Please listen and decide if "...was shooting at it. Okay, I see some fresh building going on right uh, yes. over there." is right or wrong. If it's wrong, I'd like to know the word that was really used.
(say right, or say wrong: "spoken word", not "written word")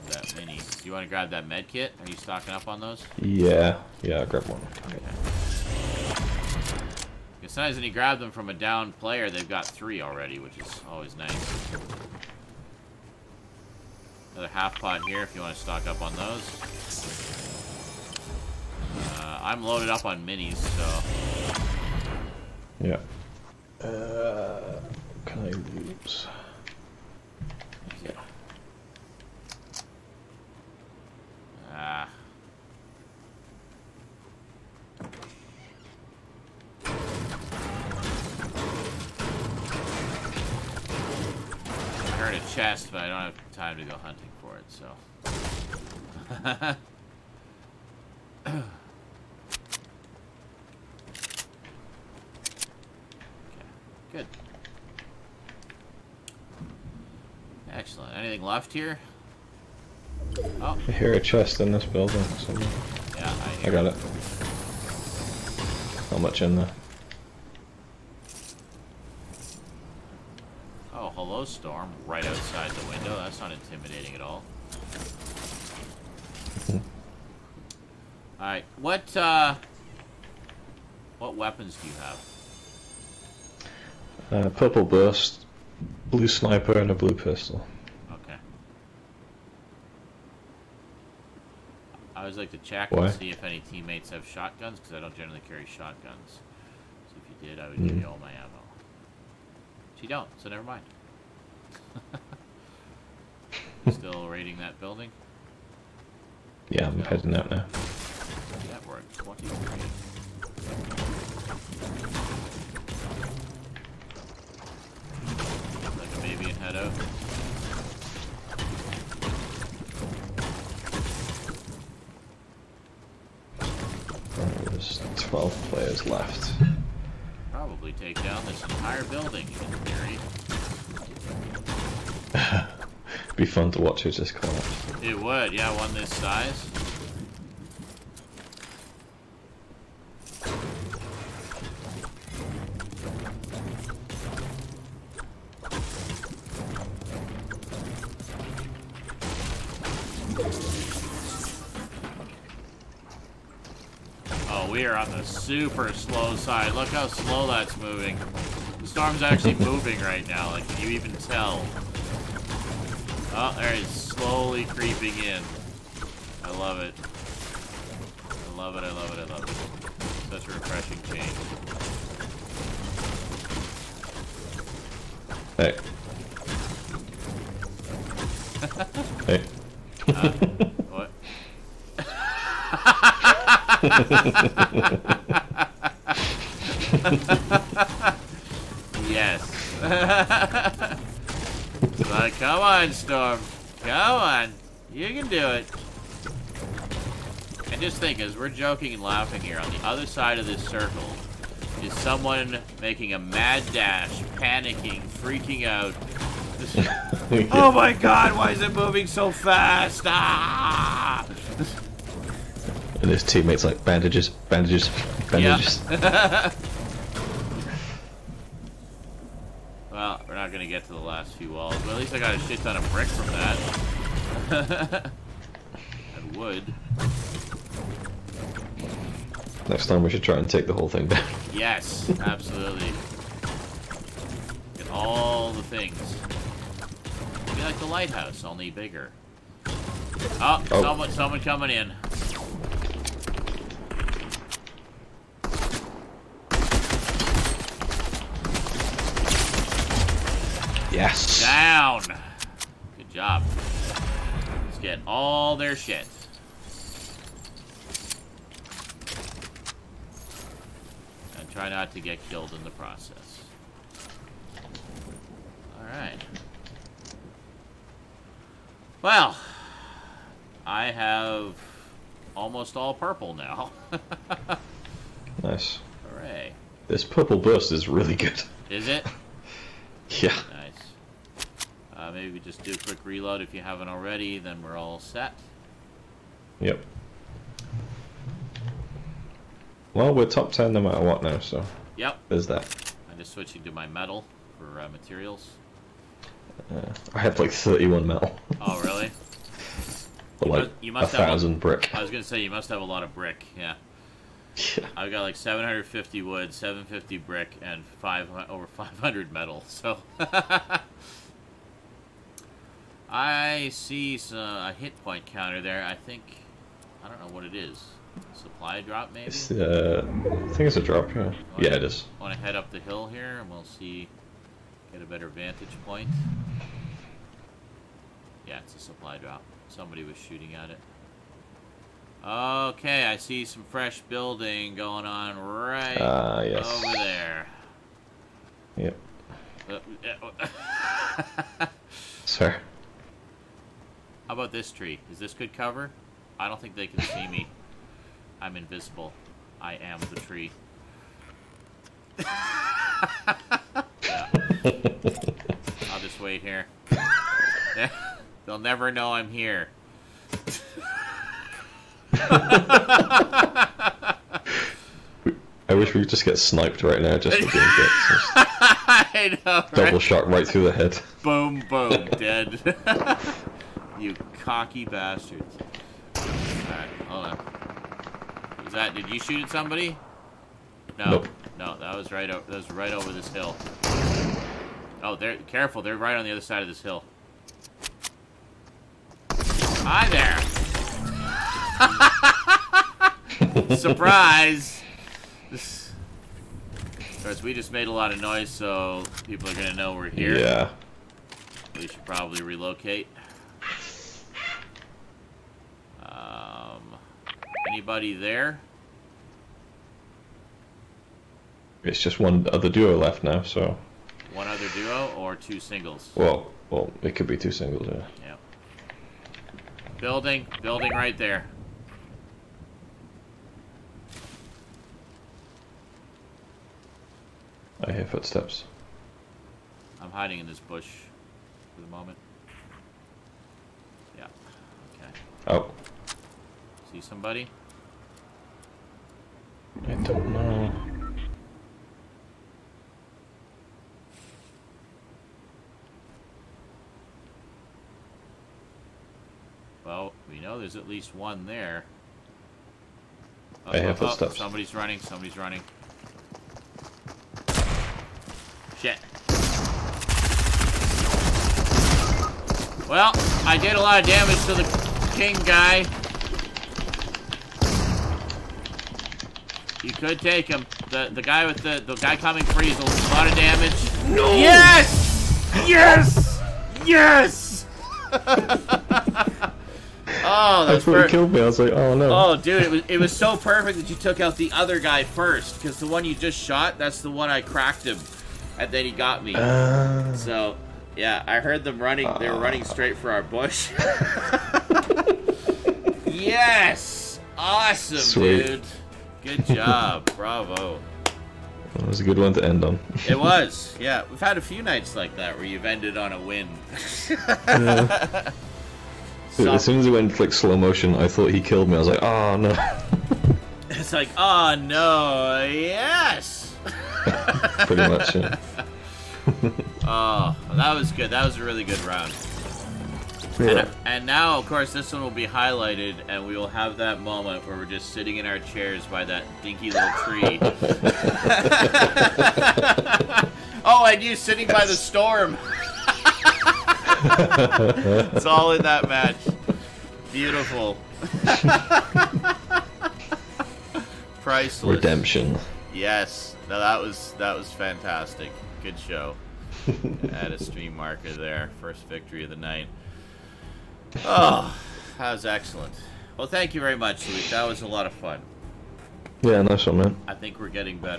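right.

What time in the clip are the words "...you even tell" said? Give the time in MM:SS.
02:40.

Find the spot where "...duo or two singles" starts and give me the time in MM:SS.
06:54.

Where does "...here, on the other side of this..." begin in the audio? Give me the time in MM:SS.
03:19.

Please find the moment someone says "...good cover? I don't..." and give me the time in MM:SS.
05:45.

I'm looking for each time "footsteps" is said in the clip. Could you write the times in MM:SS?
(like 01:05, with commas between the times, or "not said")
07:08, 07:34.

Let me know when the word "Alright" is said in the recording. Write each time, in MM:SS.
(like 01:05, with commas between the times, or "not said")
01:18, 04:25, 06:16.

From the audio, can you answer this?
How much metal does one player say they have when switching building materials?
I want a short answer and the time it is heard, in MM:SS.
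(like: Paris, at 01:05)
31, at 04:57.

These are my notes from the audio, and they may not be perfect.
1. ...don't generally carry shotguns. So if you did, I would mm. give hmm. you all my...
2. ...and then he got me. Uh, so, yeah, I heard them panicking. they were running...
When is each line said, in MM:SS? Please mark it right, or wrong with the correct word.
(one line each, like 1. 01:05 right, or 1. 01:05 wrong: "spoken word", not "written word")
1. 01:34 right
2. 08:08 wrong: "running", not "panicking".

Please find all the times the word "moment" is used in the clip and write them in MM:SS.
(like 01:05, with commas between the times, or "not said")
07:11, 08:47.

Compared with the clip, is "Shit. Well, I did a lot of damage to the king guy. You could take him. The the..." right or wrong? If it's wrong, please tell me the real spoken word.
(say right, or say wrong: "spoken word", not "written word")
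right.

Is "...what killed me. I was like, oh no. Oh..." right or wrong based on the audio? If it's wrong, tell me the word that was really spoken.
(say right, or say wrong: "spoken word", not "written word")
right.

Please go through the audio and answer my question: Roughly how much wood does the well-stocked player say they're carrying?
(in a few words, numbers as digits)
750.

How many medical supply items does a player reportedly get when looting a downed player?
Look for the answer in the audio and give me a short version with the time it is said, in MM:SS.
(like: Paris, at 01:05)
3, at 00:09.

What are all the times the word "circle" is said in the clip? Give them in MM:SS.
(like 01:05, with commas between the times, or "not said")
03:20.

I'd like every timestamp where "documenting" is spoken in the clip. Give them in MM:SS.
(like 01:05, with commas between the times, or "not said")
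not said.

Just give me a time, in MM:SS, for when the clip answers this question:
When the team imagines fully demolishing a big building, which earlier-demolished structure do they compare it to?
03:57.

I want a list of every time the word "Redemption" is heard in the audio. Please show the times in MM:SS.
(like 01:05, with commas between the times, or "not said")
09:04.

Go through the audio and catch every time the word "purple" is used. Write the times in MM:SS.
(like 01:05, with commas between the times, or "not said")
01:24, 04:32, 04:37.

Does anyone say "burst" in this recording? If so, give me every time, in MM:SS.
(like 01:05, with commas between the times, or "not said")
01:24, 04:37.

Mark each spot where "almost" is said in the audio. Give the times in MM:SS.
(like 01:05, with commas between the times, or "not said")
04:32.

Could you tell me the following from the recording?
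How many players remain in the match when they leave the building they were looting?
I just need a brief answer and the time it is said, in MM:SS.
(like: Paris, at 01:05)
12, at 02:05.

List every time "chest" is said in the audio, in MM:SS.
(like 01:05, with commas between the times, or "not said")
00:42, 01:01.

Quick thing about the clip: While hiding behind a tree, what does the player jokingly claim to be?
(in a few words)
the tree.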